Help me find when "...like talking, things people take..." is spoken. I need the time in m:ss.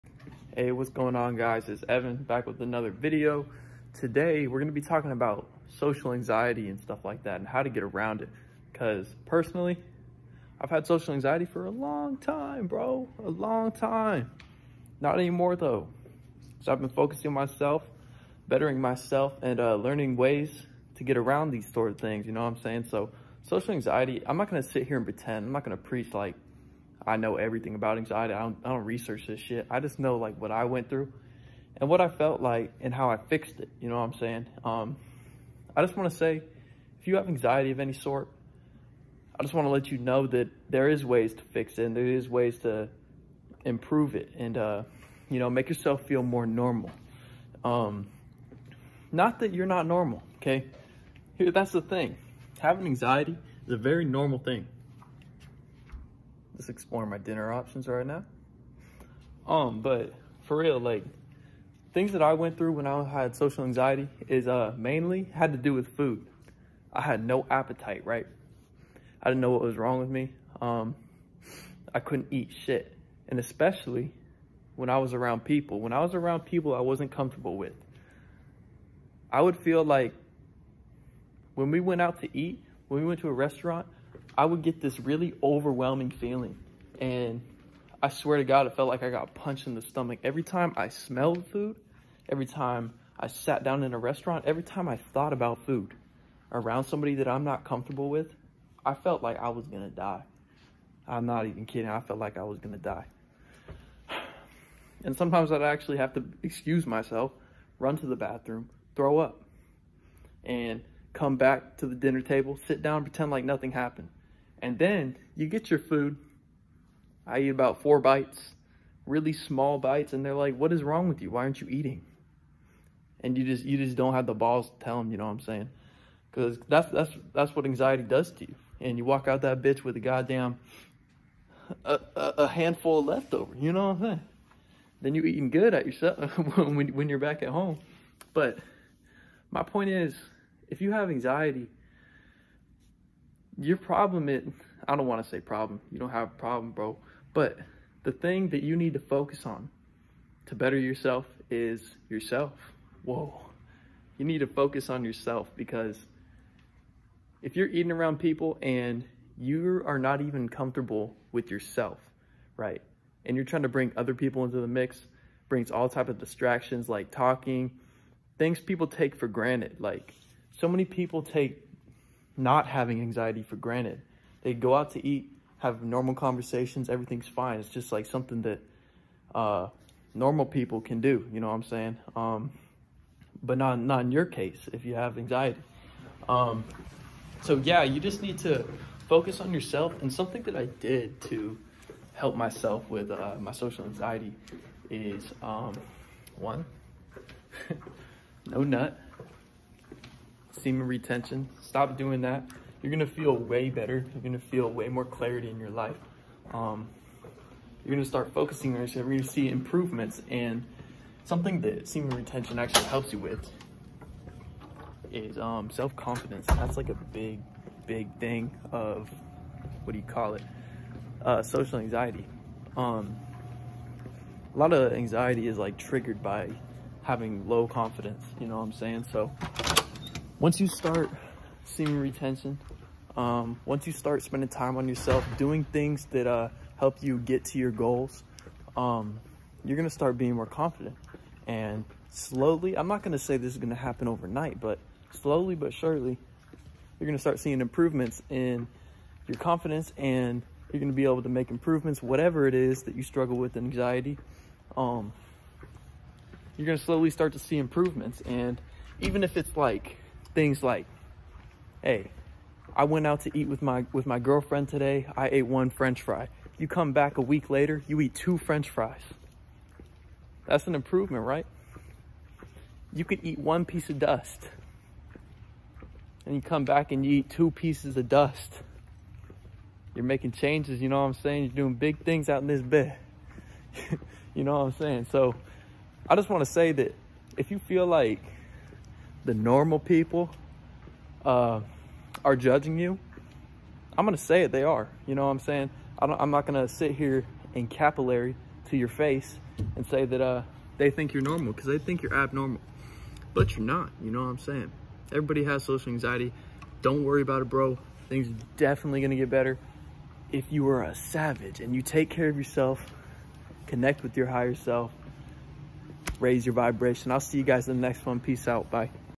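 2:46.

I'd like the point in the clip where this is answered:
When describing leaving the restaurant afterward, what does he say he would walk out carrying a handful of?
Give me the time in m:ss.
2:13.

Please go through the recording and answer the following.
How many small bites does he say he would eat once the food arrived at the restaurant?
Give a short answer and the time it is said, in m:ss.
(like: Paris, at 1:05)
4, at 1:57.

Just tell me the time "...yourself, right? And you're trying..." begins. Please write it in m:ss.
2:41.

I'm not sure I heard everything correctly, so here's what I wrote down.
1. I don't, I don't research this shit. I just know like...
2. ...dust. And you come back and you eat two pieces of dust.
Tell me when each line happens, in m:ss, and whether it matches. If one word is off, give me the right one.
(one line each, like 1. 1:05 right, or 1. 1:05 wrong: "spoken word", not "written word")
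1. 0:28 right
2. 4:33 right.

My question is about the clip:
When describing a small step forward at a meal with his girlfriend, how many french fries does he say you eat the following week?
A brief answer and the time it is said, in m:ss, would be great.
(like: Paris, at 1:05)
2, at 4:28.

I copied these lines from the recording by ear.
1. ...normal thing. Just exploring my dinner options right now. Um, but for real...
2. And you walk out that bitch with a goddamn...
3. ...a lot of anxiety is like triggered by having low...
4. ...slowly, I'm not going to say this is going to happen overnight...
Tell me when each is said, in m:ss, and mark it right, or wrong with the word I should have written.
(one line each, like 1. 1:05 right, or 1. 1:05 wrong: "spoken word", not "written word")
1. 0:54 right
2. 2:08 right
3. 3:44 right
4. 4:02 right.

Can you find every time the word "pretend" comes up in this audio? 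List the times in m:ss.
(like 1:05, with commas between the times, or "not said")
0:25, 1:53.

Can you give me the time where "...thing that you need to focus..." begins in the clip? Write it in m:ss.
2:28.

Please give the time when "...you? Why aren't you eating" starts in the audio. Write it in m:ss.
2:01.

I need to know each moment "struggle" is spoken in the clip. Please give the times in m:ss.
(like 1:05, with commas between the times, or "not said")
4:13.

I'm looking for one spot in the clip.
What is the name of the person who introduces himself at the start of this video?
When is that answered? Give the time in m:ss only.
0:01.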